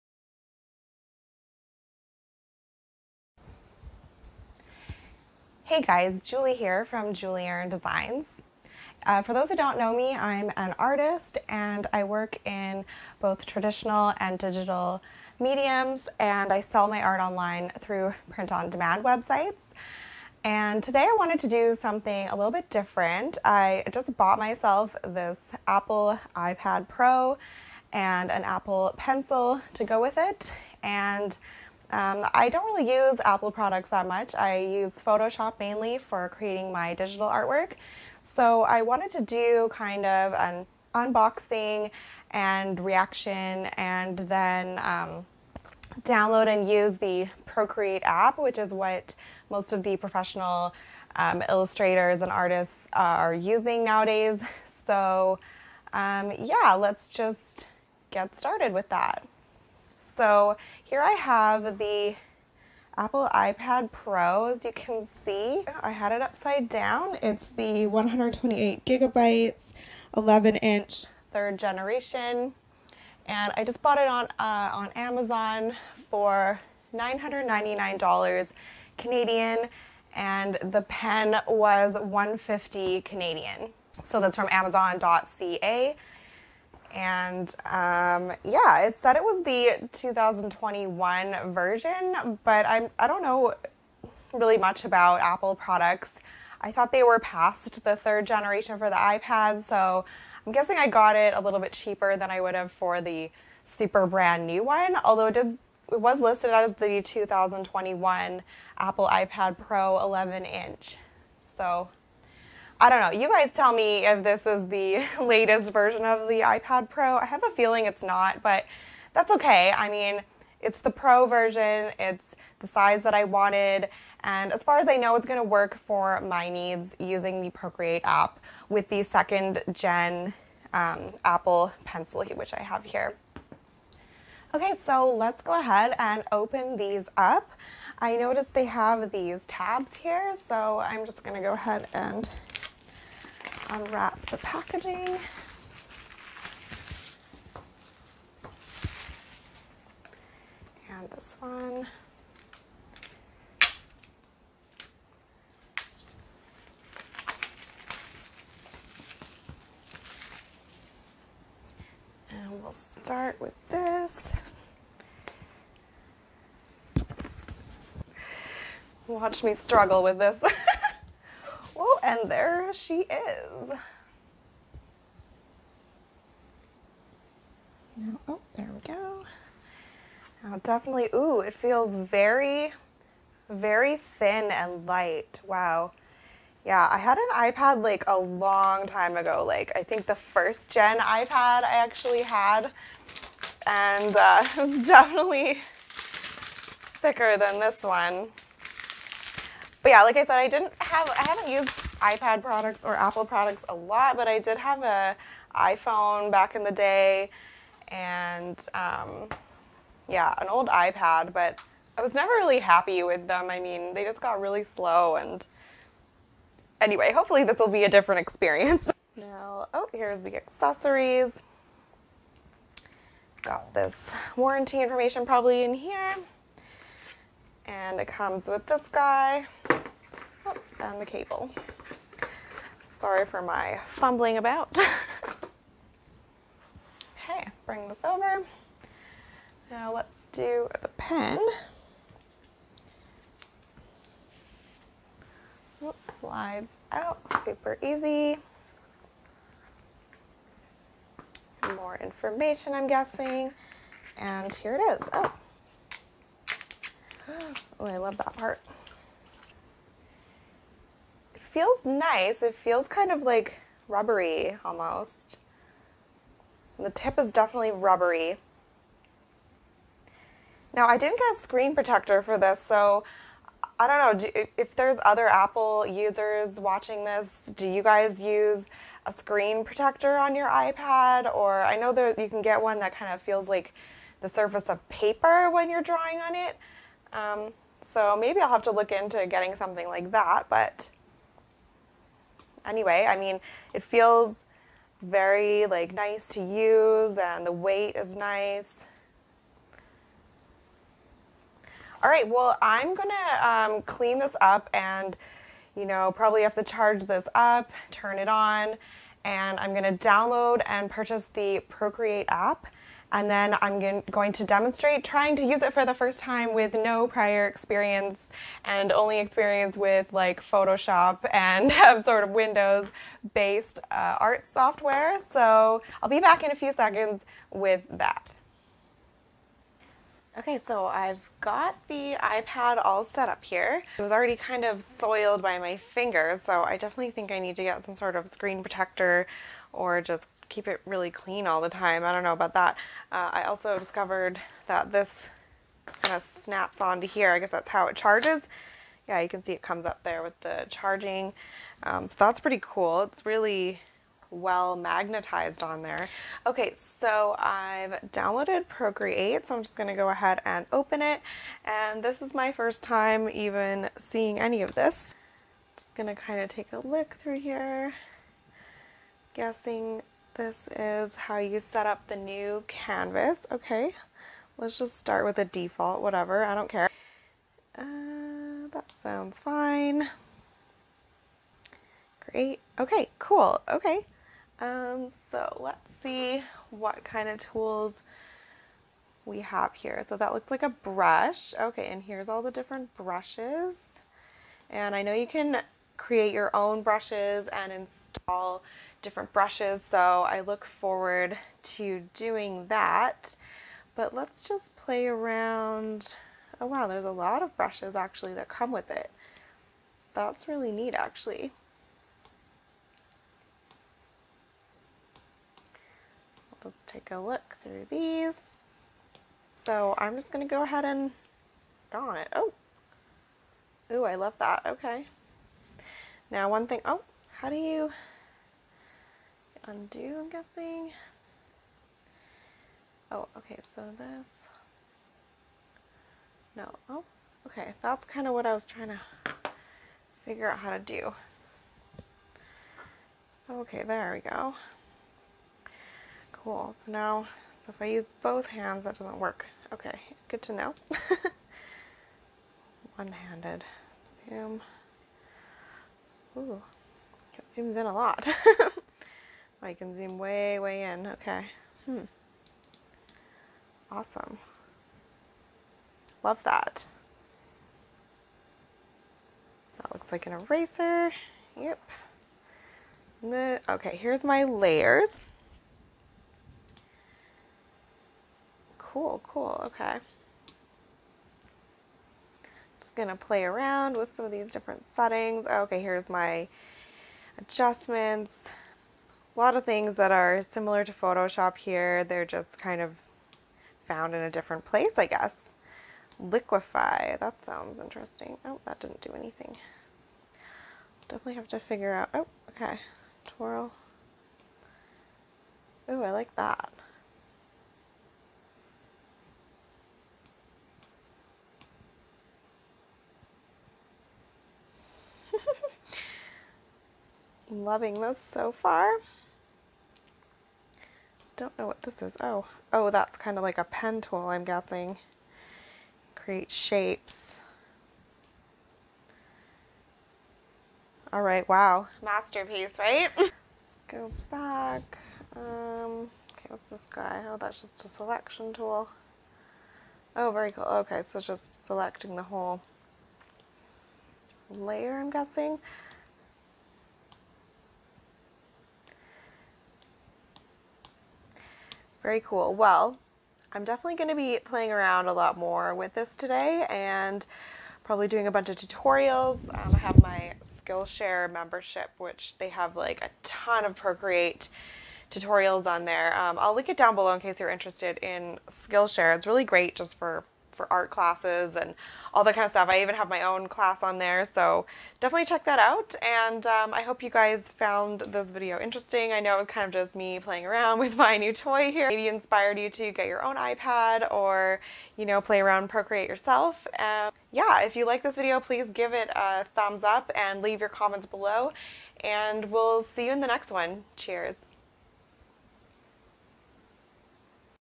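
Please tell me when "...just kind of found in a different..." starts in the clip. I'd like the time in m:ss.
8:12.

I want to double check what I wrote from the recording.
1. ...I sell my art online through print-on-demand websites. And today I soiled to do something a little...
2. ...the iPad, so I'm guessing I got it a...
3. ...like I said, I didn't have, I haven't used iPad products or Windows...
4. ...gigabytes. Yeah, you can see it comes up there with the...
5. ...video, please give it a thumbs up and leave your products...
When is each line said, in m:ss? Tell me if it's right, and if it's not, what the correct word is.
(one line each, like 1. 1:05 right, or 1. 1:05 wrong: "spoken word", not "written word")
1. 0:16 wrong: "wanted", not "soiled"
2. 1:38 right
3. 3:20 wrong: "Apple", not "Windows"
4. 5:47 wrong: "charges", not "gigabytes"
5. 9:48 wrong: "comments", not "products".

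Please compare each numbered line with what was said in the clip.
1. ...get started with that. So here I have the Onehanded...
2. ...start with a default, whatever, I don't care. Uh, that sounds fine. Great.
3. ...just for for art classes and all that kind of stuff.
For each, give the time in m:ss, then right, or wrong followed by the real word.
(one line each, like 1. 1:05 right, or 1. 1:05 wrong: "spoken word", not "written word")
1. 0:58 wrong: "Apple", not "Onehanded"
2. 6:14 right
3. 9:29 right.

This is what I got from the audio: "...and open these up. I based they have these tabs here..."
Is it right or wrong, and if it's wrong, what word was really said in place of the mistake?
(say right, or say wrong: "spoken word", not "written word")
wrong: "noticed", not "based".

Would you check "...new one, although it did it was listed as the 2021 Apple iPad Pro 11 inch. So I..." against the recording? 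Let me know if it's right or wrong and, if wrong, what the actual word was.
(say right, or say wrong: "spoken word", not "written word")
right.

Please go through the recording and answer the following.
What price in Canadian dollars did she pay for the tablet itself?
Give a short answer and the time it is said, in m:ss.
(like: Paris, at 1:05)
$999, at 1:16.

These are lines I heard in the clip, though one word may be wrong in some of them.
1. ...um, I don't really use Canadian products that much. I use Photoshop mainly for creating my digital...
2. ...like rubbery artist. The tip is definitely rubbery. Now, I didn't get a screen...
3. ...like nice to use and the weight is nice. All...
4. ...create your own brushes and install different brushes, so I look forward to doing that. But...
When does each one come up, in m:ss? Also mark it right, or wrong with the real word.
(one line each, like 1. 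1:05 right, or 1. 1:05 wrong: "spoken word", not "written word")
1. 0:31 wrong: "Apple", not "Canadian"
2. 4:23 wrong: "almost", not "artist"
3. 4:55 right
4. 6:35 right.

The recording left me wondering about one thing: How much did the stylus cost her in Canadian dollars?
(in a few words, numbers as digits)
150.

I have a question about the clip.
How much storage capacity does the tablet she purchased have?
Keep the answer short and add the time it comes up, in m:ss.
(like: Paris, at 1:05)
128 gigabytes, at 1:07.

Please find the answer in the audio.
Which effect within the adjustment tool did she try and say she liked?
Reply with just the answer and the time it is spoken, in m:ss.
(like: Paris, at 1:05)
Twirl, at 8:23.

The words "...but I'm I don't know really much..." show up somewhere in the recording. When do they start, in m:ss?
1:32.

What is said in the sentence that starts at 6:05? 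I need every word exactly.
Just gonna kind of take a look through here.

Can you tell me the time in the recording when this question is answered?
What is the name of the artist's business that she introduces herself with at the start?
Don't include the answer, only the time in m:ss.
0:07.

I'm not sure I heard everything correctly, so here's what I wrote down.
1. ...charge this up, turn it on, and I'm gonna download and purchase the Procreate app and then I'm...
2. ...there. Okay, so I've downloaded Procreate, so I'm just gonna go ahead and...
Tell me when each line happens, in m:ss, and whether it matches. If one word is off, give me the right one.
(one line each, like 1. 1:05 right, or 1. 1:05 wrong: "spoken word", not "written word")
1. 5:06 right
2. 5:55 right.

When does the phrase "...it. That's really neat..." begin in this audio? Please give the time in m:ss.
6:48.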